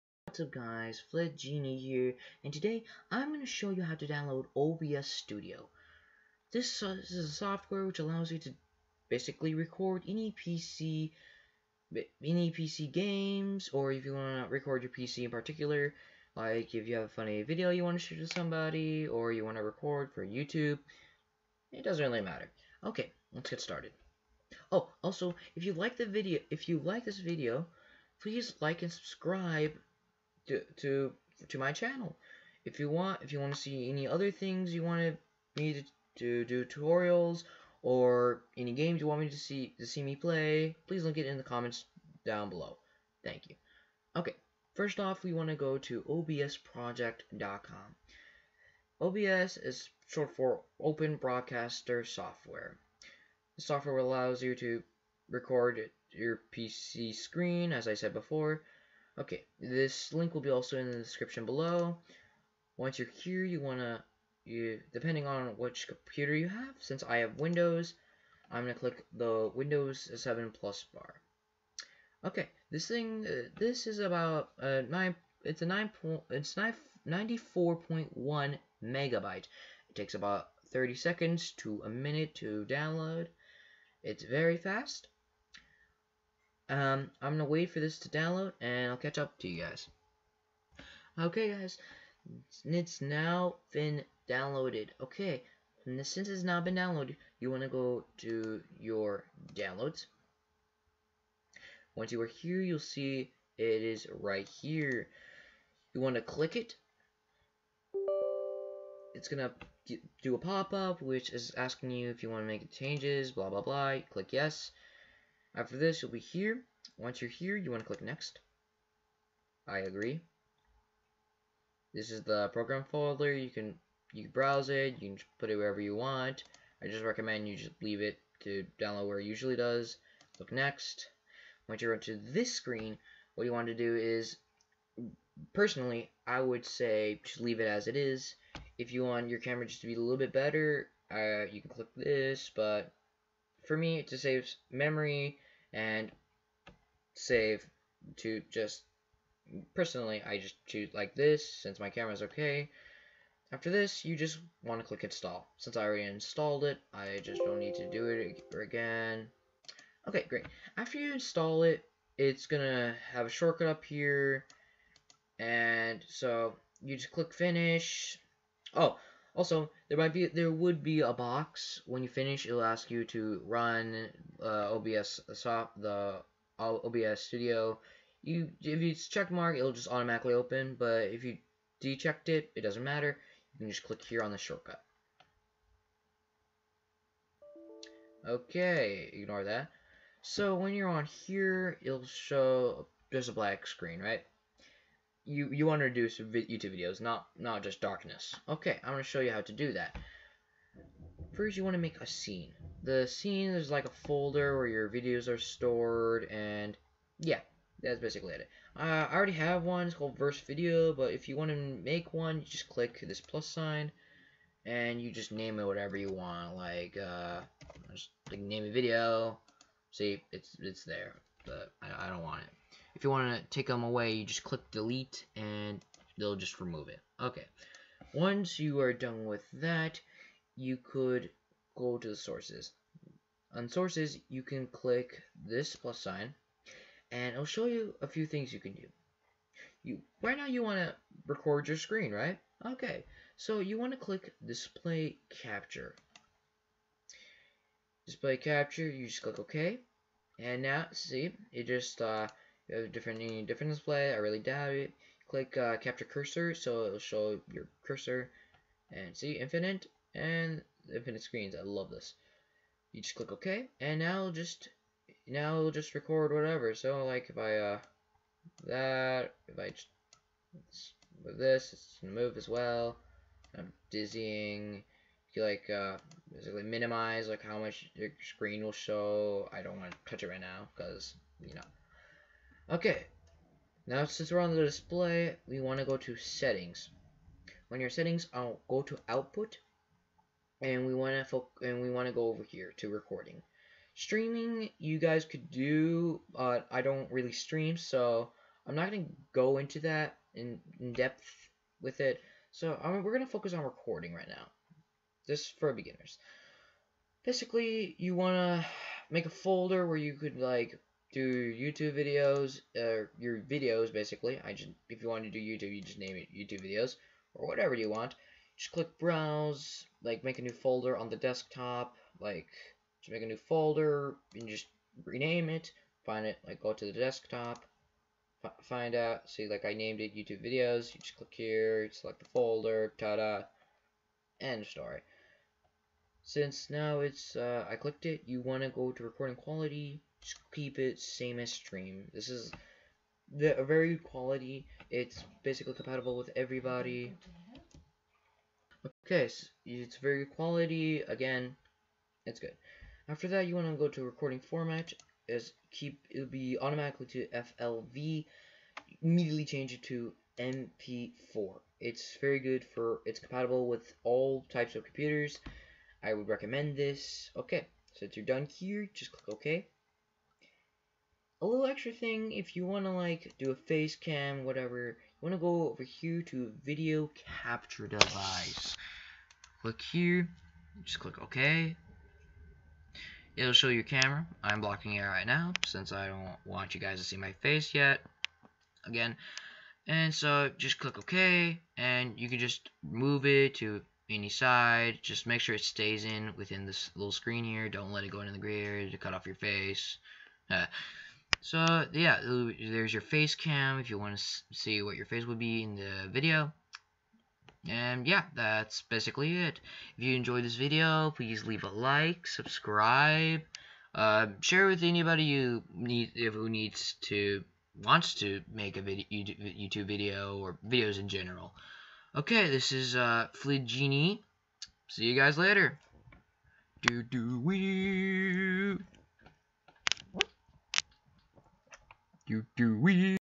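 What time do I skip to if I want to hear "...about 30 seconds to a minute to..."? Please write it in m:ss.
1:20.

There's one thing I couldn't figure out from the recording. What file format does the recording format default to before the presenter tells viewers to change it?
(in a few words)
FLV.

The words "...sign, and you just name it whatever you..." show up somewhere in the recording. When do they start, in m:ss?
3:33.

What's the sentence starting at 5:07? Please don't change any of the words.
Basically, you wanna make a folder where you could like do YouTube videos, uh, your videos basically.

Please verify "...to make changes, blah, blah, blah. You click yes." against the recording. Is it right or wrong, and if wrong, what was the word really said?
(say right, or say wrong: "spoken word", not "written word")
right.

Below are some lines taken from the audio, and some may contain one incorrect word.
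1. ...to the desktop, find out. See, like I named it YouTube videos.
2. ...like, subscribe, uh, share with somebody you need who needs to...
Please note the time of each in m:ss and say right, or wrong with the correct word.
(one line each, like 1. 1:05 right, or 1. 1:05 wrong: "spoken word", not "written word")
1. 5:26 right
2. 6:51 wrong: "anybody", not "somebody".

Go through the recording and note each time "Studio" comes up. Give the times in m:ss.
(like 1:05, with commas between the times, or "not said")
0:05, 2:57.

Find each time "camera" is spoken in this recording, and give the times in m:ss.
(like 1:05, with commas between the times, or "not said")
2:19, 2:31, 6:23.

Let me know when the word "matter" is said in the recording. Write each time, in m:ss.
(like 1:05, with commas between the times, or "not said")
0:22, 3:02.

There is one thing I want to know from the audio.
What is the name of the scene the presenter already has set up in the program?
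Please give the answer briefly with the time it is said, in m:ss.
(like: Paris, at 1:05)
Verse Video, at 3:30.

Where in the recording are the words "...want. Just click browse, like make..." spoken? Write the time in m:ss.
5:17.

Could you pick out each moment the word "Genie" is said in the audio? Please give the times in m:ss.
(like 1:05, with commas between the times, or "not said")
0:01, 7:03.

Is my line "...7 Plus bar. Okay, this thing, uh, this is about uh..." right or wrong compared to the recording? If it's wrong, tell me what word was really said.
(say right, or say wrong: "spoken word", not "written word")
right.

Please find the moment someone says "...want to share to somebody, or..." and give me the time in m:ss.
0:17.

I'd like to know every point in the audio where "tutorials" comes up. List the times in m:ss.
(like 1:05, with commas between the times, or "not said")
0:36.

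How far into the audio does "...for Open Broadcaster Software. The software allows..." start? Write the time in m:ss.
0:50.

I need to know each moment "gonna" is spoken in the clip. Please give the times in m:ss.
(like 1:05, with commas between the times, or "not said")
1:27, 2:42, 3:18, 4:32, 4:58, 5:03.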